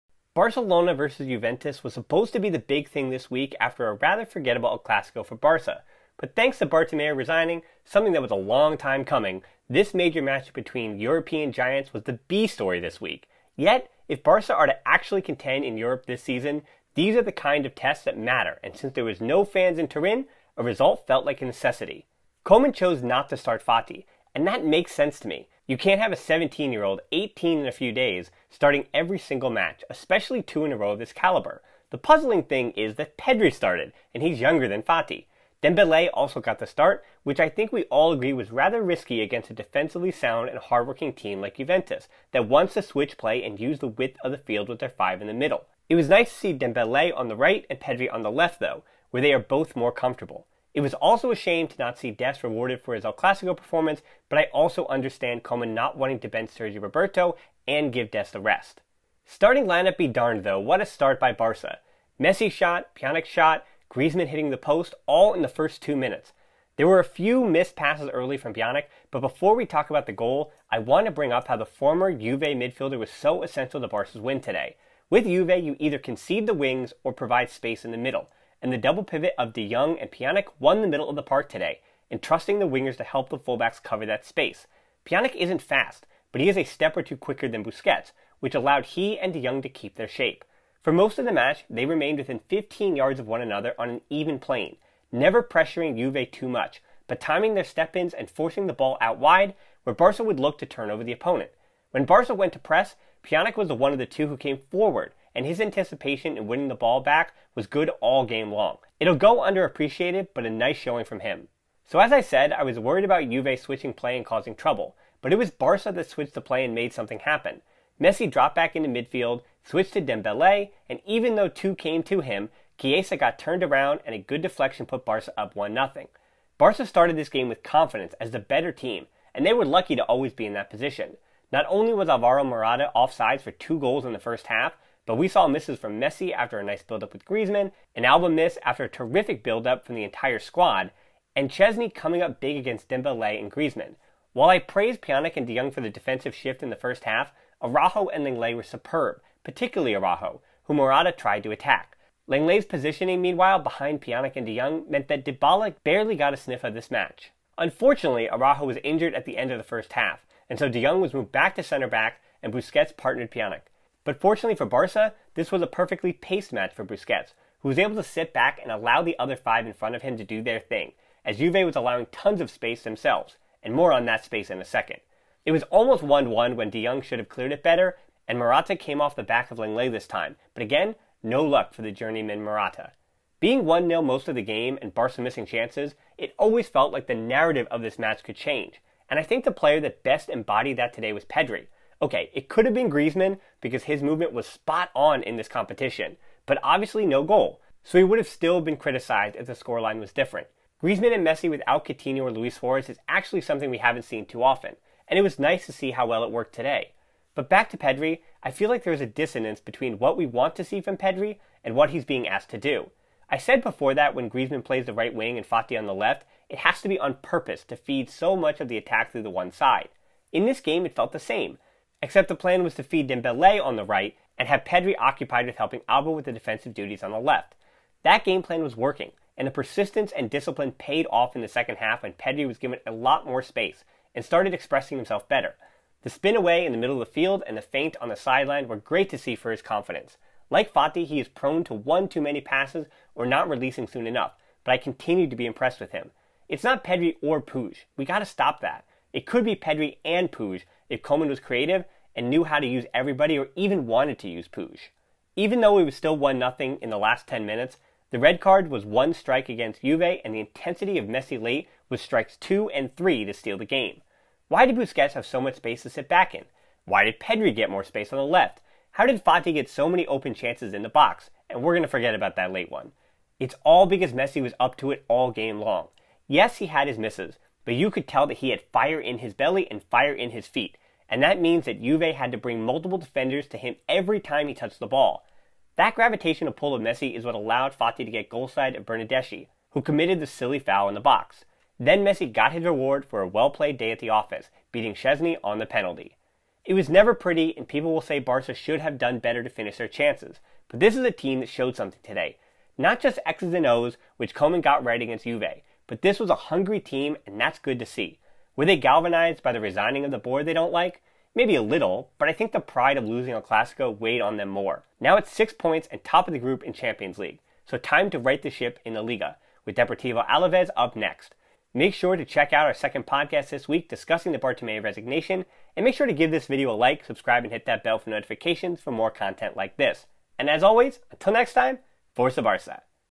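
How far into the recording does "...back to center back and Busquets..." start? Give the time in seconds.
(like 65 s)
161 s.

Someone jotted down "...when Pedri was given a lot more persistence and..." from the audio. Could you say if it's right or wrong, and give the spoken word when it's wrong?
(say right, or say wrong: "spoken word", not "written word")
wrong: "space", not "persistence".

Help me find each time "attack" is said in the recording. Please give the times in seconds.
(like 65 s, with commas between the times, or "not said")
151 s, 218 s.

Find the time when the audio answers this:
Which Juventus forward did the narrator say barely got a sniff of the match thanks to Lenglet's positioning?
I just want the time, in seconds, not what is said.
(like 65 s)
155 s.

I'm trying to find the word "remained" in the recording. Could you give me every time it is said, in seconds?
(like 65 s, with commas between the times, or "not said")
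91 s.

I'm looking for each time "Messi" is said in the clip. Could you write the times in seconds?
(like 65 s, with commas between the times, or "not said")
62 s, 118 s, 135 s, 201 s, 261 s, 274 s, 286 s, 292 s.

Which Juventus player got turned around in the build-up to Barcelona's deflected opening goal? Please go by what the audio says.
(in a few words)
Chiesa.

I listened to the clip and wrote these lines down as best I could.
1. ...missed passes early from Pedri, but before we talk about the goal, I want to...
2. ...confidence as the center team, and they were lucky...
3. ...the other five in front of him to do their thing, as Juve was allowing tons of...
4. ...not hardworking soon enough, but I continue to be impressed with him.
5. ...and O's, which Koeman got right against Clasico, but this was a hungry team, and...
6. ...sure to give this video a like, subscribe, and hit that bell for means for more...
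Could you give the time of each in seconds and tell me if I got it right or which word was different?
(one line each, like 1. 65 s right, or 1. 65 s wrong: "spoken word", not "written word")
1. 67 s wrong: "Pjanic", not "Pedri"
2. 127 s wrong: "better", not "center"
3. 169 s right
4. 243 s wrong: "releasing", not "hardworking"
5. 303 s wrong: "Juve", not "Clasico"
6. 325 s wrong: "notifications", not "means".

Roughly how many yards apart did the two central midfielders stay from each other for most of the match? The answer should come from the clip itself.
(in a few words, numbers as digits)
15.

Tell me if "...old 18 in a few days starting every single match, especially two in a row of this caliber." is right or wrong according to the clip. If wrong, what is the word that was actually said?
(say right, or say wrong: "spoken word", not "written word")
right.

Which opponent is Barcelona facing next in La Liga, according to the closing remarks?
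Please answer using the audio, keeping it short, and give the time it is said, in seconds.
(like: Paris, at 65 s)
Deportivo Alaves, at 319 s.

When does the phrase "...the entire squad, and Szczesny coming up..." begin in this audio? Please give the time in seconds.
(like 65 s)
139 s.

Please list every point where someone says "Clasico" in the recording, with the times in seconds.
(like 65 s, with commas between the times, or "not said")
4 s, 53 s, 313 s.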